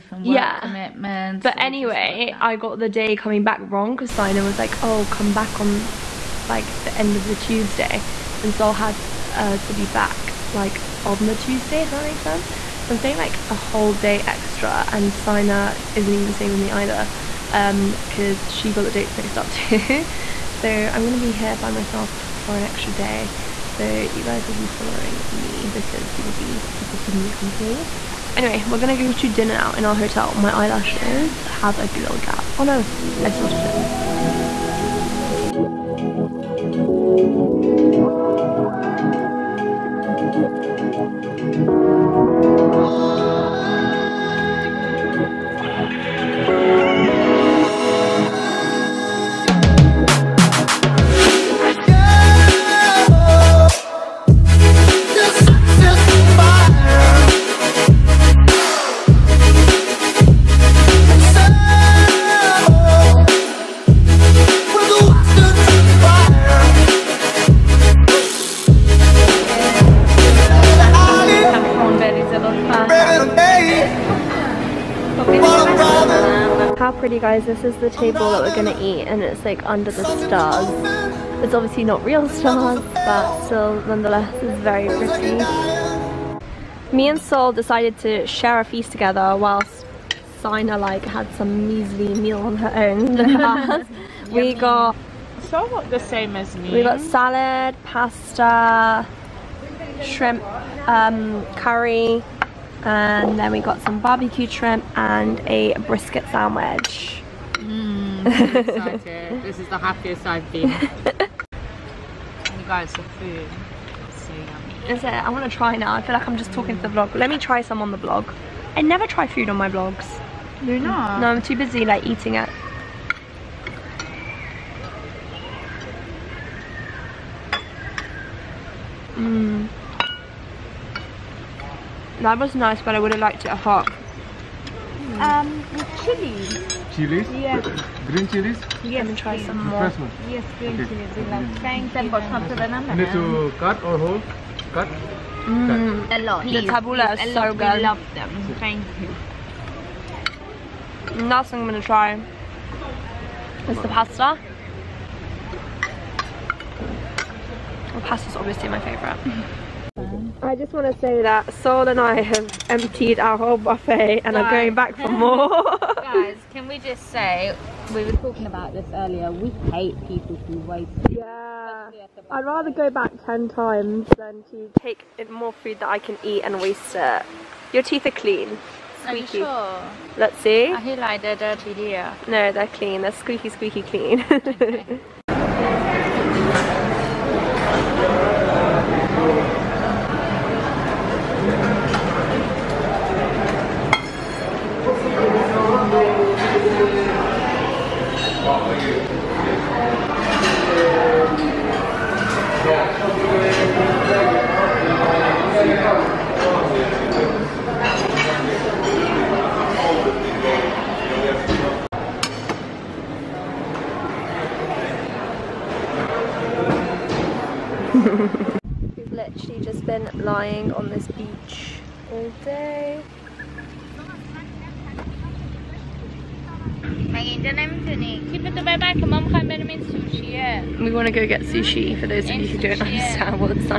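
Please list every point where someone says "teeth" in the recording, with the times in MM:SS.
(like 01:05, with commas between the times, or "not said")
02:57.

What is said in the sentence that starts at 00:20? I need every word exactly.
so I'm gonna be here by myself for an extra day.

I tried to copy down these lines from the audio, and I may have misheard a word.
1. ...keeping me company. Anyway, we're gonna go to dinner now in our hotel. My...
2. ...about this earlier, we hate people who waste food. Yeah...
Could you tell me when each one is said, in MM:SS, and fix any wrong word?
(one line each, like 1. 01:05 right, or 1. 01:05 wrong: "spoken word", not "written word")
1. 00:26 right
2. 02:48 right.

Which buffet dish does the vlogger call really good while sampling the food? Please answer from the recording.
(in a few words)
Tabbouleh.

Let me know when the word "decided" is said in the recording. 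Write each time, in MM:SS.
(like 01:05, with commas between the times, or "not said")
01:27.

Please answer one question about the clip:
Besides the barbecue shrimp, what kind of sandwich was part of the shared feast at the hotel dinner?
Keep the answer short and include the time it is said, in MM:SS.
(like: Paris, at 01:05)
Brisket sandwich, at 01:45.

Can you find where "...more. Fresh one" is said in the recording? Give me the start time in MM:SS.
02:19.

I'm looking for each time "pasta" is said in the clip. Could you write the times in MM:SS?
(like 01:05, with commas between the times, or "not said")
01:37, 02:33.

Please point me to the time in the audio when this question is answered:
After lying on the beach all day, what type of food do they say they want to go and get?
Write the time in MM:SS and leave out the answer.
03:51.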